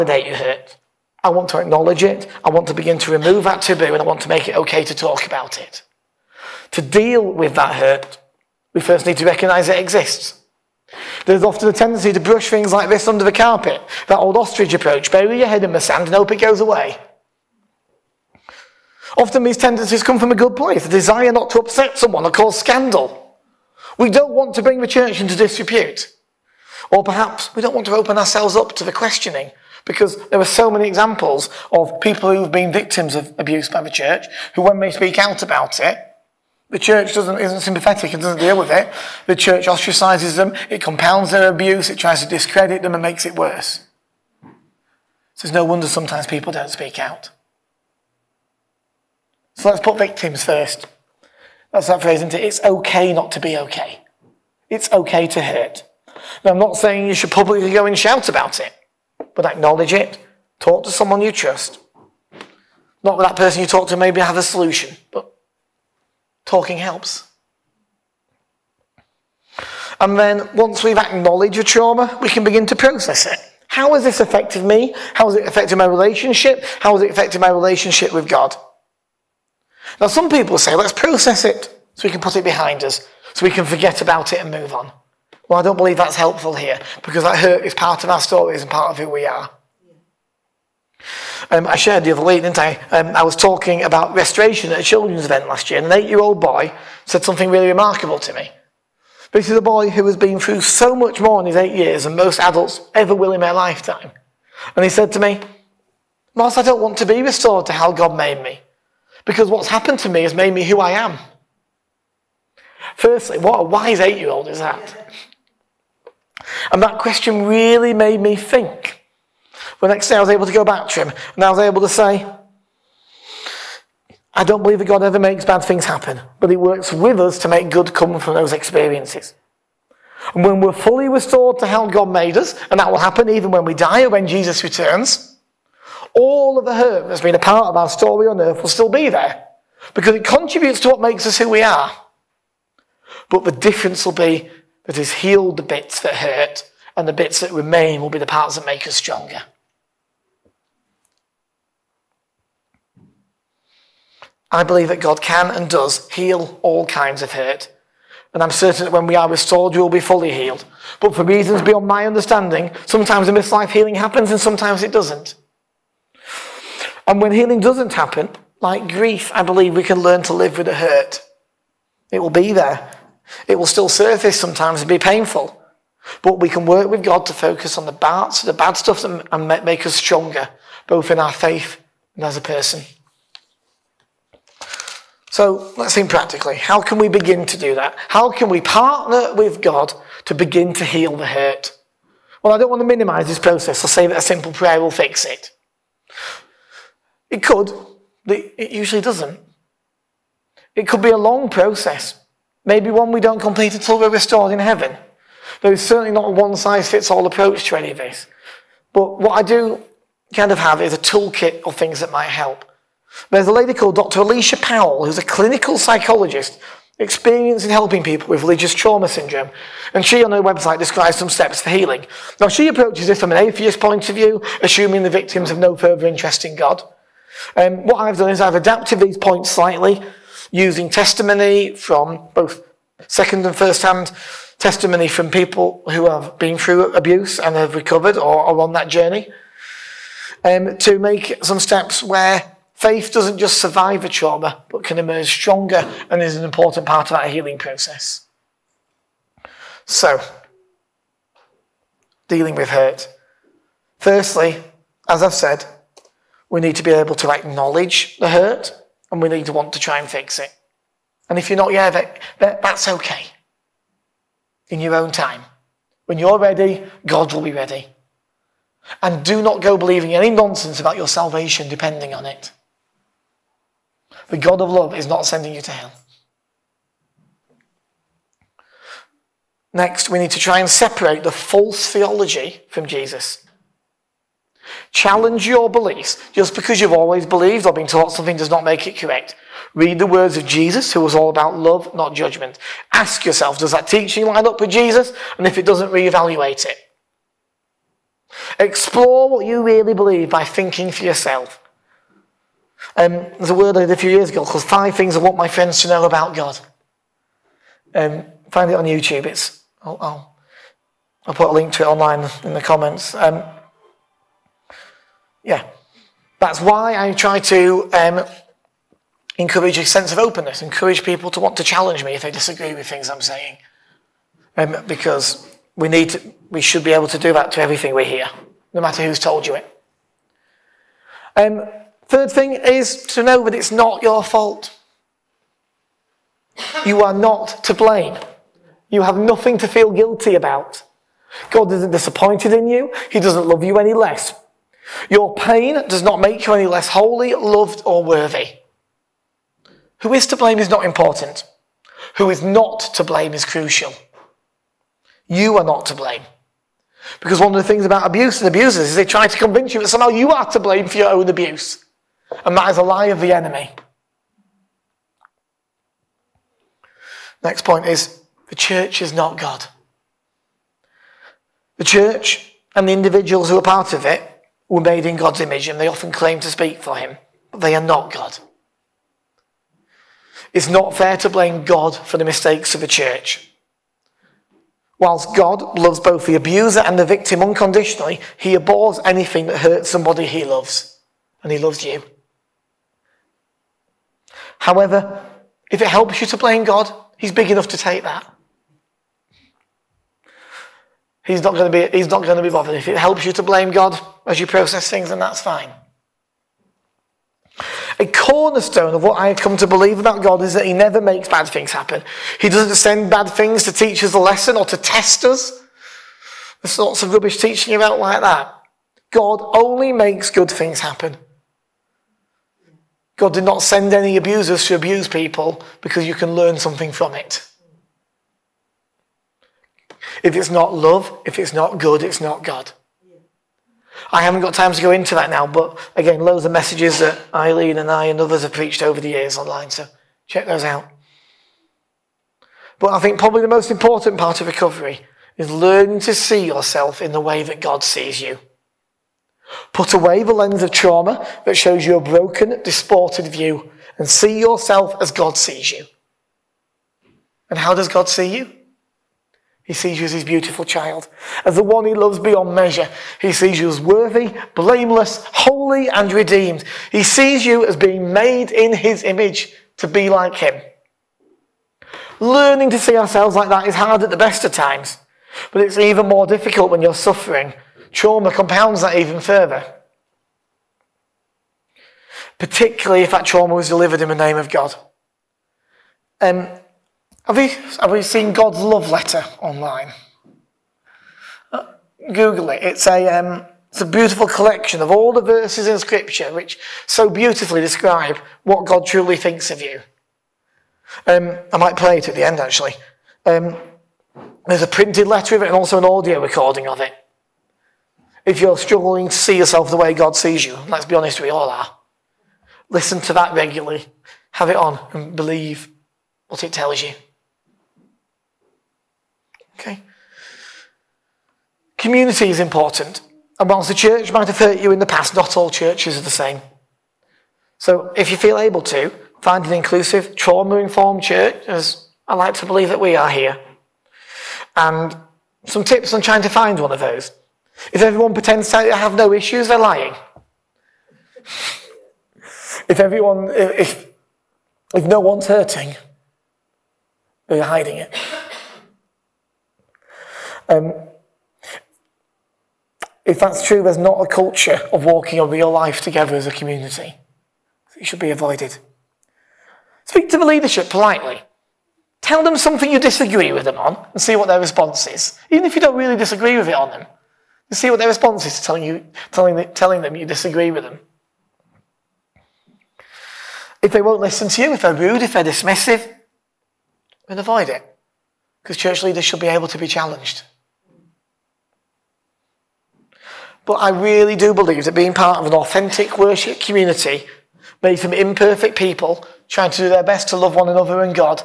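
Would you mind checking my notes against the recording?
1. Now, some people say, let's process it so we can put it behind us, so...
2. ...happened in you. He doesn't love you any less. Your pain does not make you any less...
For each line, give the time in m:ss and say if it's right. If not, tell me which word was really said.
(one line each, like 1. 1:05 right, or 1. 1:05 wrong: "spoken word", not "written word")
1. 1:19 right
2. 5:41 wrong: "disappointed", not "happened".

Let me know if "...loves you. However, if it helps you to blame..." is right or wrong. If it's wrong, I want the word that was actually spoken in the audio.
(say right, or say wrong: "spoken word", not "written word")
right.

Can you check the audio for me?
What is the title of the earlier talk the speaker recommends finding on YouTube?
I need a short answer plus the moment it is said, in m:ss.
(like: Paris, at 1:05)
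Five Things I Want My Friends to Know About God, at 5:04.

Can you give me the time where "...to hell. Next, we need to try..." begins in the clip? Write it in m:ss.
4:35.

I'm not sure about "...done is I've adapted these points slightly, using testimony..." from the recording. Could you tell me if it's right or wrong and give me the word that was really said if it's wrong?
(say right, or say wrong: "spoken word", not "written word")
right.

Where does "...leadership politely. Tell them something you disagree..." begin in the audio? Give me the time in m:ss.
9:20.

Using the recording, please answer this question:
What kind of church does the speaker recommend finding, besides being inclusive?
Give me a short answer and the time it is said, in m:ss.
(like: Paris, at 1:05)
Trauma informed, at 8:50.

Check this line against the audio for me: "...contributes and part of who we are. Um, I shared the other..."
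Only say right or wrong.
wrong.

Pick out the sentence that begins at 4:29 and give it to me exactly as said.
And do not go believing any nonsense about your salvation depending on it.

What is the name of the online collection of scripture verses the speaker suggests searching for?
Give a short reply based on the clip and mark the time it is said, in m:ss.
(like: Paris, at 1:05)
God's love letter, at 8:08.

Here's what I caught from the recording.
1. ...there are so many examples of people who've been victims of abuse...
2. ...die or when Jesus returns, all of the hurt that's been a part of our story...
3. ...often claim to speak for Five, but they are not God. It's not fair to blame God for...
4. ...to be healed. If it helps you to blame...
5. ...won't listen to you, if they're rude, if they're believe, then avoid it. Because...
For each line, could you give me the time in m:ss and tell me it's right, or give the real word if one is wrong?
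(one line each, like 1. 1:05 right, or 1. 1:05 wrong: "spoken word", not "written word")
1. 0:30 right
2. 2:13 right
3. 6:15 wrong: "Him", not "Five"
4. 6:42 wrong: "bothered", not "healed"
5. 9:33 wrong: "dismissive", not "believe".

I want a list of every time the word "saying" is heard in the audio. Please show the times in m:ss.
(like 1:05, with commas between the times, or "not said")
0:56, 5:23.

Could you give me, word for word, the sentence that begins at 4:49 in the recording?
Read the words of Jesus, who was all about love, not judgment.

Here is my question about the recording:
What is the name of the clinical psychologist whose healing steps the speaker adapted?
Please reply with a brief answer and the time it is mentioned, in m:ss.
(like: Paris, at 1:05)
Dr. Alicia Powell, at 3:33.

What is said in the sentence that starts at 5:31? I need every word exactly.
Um, Third thing is to know that it's not your fault.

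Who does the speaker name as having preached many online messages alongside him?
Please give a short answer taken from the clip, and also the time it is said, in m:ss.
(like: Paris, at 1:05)
Eileen, at 7:17.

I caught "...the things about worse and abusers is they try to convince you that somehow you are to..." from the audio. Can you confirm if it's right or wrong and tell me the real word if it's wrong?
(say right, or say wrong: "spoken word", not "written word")
wrong: "abuse", not "worse".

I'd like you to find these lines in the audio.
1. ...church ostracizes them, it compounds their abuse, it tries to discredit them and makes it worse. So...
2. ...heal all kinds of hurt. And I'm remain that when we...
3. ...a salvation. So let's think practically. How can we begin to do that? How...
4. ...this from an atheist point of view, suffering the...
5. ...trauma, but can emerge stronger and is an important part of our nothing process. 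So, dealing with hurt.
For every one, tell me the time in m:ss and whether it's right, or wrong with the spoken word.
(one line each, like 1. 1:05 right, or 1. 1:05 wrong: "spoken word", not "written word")
1. 0:39 right
2. 2:36 wrong: "certain", not "remain"
3. 3:02 wrong: "person", not "salvation"
4. 3:43 wrong: "assuming", not "suffering"
5. 4:04 wrong: "healing", not "nothing".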